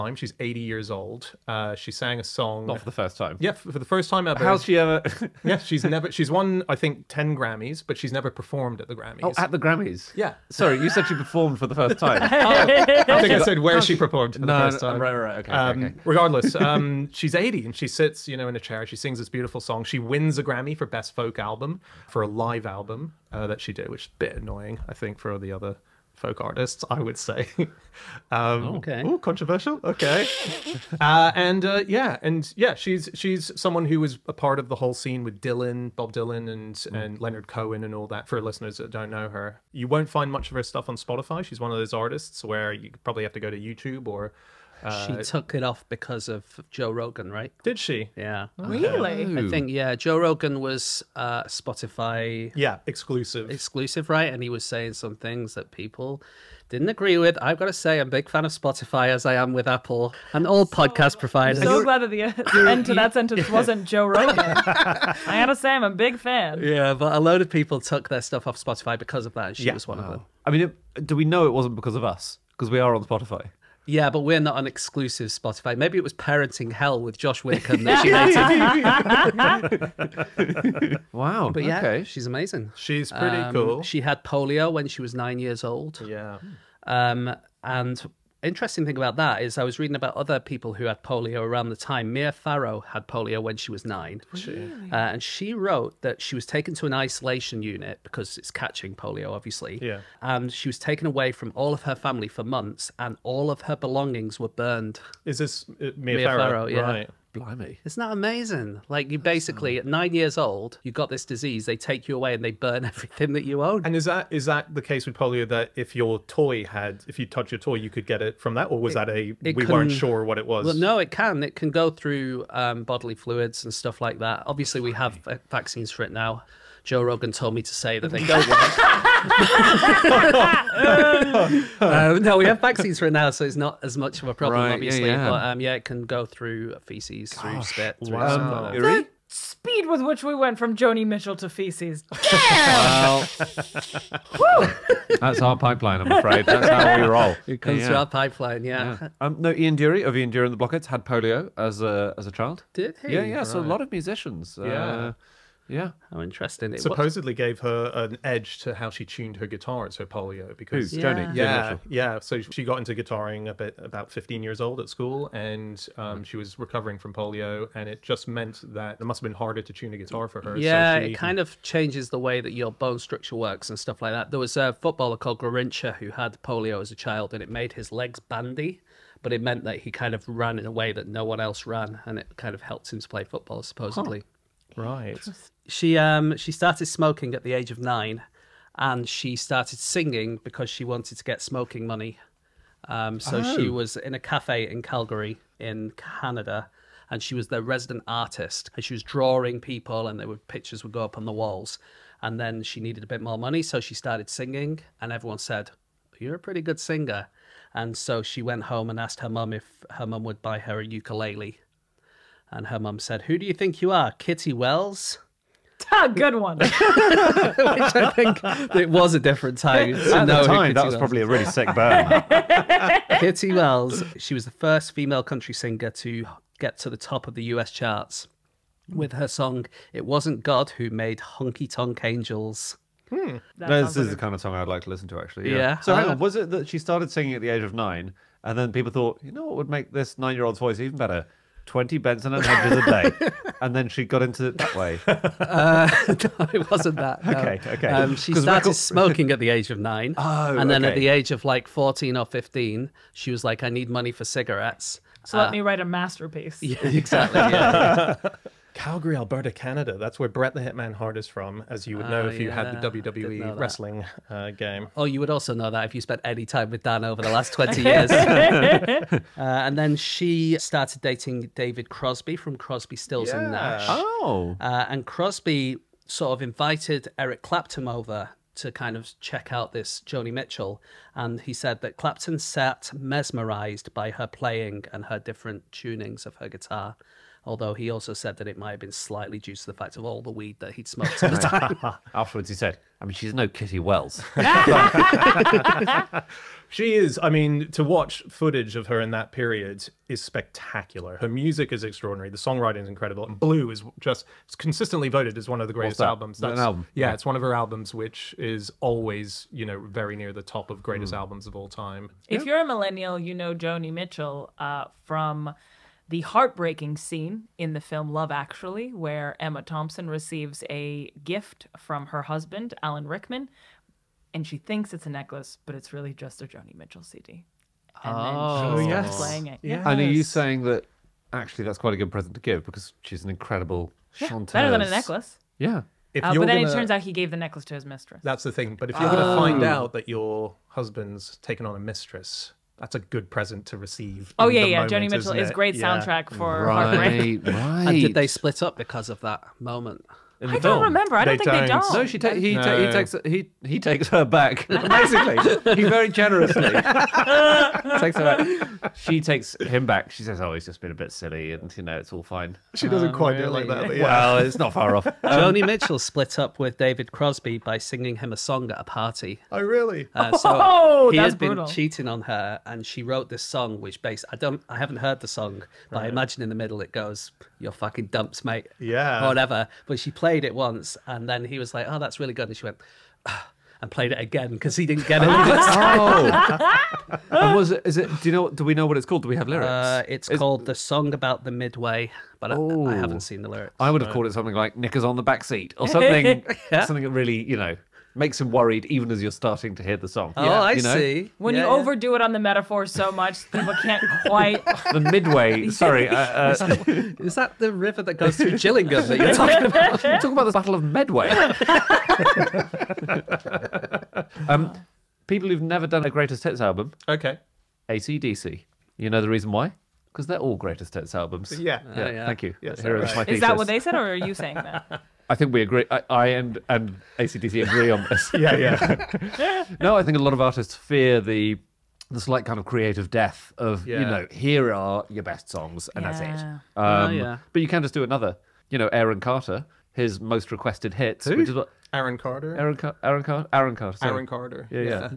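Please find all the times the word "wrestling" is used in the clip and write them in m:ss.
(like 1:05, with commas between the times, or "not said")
4:23.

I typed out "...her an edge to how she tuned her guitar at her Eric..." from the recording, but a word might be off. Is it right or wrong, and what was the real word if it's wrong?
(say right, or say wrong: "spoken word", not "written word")
wrong: "Polio", not "Eric".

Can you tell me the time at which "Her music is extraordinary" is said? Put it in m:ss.
5:01.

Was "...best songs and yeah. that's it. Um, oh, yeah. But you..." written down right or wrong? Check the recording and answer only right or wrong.
right.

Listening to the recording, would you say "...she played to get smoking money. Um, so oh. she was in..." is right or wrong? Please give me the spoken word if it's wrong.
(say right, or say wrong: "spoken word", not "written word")
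wrong: "wanted", not "played".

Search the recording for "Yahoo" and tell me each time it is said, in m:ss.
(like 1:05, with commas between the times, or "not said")
not said.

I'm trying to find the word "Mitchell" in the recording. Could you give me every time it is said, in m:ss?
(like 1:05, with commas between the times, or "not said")
2:21, 4:40, 5:13, 5:26, 5:45, 6:05.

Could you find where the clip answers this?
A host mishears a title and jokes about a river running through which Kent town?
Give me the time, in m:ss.
6:48.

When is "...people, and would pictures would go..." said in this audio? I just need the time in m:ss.
3:19.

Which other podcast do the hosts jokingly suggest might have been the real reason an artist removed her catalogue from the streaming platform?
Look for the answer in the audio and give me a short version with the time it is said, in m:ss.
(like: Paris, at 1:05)
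Parenting Hell, at 1:16.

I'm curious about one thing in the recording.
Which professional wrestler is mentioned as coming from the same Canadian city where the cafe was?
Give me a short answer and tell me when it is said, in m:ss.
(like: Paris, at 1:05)
Brett the Hitman Hart, at 4:20.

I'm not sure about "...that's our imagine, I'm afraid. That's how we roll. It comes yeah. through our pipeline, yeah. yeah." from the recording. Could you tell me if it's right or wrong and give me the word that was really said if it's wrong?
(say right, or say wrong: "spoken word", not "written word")
wrong: "pipeline", not "imagine".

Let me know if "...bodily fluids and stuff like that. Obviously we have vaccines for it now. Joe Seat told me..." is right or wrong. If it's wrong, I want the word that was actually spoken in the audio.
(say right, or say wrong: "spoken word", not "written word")
wrong: "Rogan", not "Seat".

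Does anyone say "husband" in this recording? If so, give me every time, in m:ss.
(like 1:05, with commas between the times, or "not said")
5:22, 5:40.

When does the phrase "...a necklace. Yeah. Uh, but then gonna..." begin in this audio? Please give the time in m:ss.
5:34.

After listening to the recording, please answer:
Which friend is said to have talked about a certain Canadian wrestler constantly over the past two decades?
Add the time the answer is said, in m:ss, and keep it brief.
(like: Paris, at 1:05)
Dan, at 4:26.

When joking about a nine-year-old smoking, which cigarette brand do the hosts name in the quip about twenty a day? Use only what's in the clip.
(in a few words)
Benson and Hedges.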